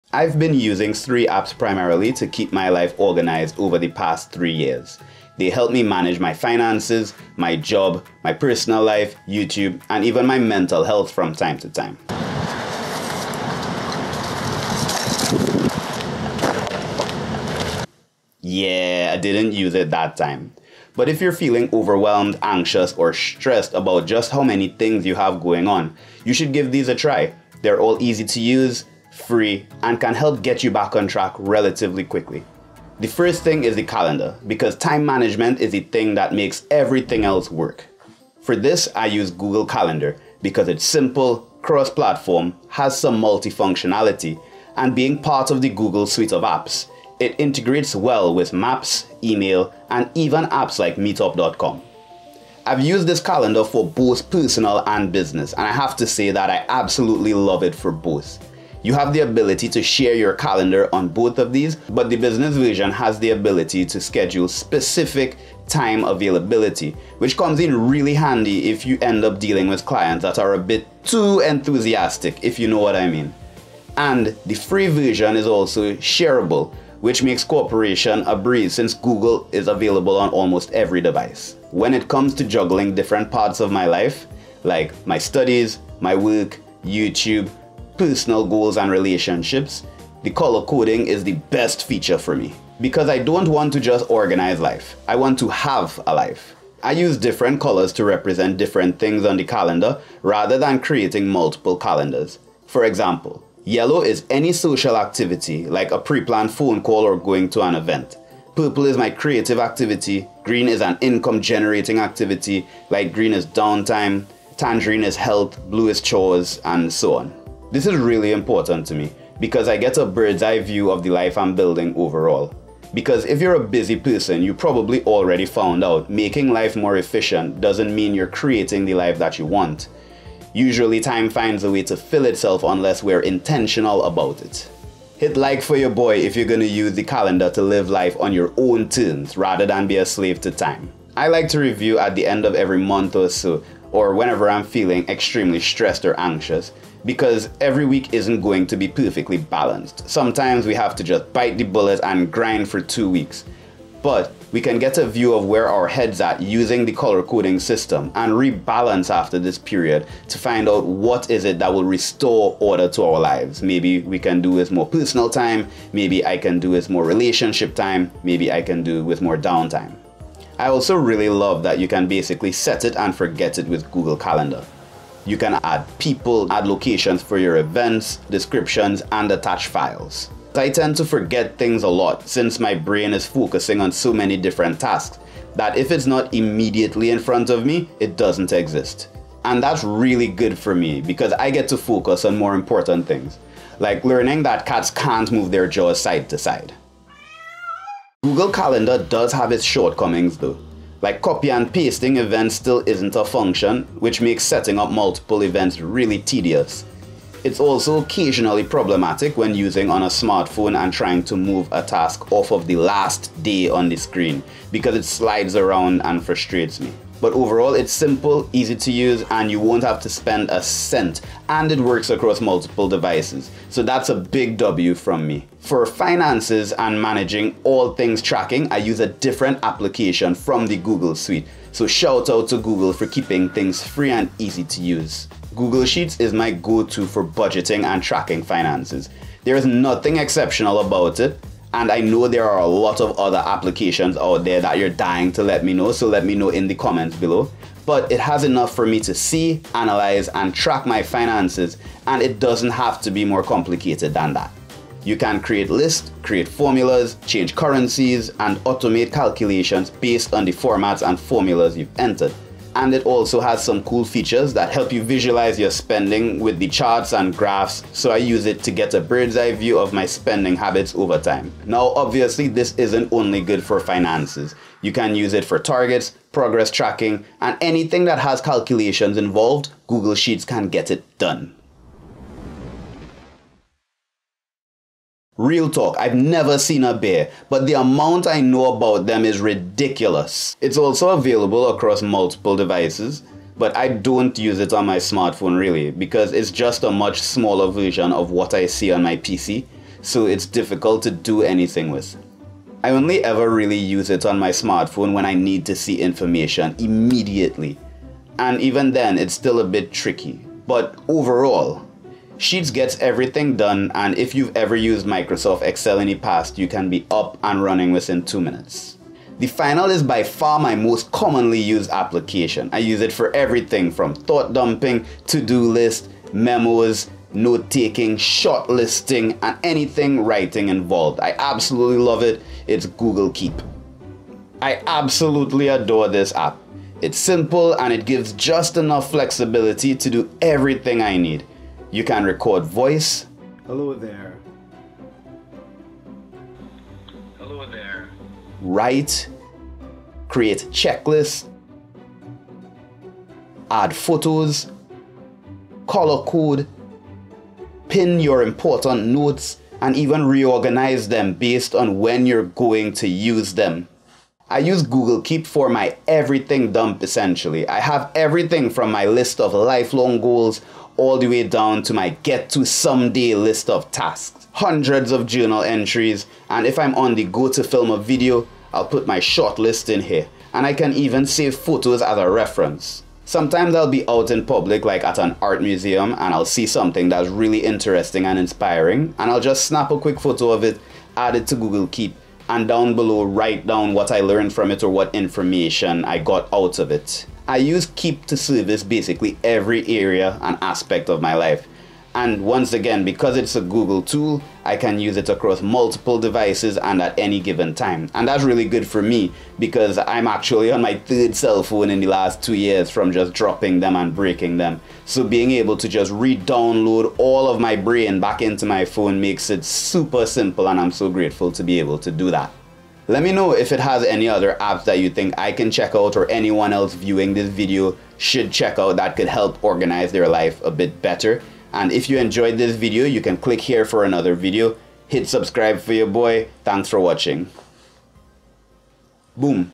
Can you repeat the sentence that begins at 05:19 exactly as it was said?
The final is by far my most commonly used application.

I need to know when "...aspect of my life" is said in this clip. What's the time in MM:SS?
06:40.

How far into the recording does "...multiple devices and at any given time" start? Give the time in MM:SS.
06:45.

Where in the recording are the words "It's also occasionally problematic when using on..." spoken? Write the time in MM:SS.
03:27.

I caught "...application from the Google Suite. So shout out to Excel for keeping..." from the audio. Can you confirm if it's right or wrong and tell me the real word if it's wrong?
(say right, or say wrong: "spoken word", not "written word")
wrong: "Google", not "Excel".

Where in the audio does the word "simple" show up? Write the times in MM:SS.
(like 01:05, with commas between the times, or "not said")
00:40, 03:37, 05:37, 07:00.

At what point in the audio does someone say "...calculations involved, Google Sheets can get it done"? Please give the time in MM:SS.
04:38.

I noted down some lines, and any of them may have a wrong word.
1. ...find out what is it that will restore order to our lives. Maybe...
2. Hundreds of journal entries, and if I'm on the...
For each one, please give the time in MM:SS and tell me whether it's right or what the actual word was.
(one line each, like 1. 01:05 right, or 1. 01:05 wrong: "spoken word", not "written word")
1. 02:40 right
2. 06:14 right.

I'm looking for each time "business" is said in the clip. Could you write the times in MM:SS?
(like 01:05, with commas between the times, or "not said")
00:55, 01:02.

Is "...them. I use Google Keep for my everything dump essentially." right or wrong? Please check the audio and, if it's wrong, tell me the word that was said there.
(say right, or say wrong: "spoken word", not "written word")
right.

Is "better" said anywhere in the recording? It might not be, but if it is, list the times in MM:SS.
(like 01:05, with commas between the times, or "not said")
07:11.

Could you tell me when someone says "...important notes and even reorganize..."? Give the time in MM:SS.
05:58.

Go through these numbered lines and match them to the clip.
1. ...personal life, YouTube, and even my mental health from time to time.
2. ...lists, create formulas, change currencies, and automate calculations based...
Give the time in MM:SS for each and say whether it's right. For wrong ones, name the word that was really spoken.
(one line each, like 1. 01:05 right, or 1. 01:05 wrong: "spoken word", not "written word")
1. 00:08 right
2. 04:15 right.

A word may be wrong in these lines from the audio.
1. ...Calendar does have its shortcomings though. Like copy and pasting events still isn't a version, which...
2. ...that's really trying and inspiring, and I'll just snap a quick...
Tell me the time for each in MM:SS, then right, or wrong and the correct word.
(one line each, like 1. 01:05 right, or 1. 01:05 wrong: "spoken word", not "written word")
1. 03:18 wrong: "function", not "version"
2. 06:27 wrong: "interesting", not "trying".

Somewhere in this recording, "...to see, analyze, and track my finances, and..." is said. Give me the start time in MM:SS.
04:09.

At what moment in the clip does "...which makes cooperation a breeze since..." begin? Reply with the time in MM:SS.
01:17.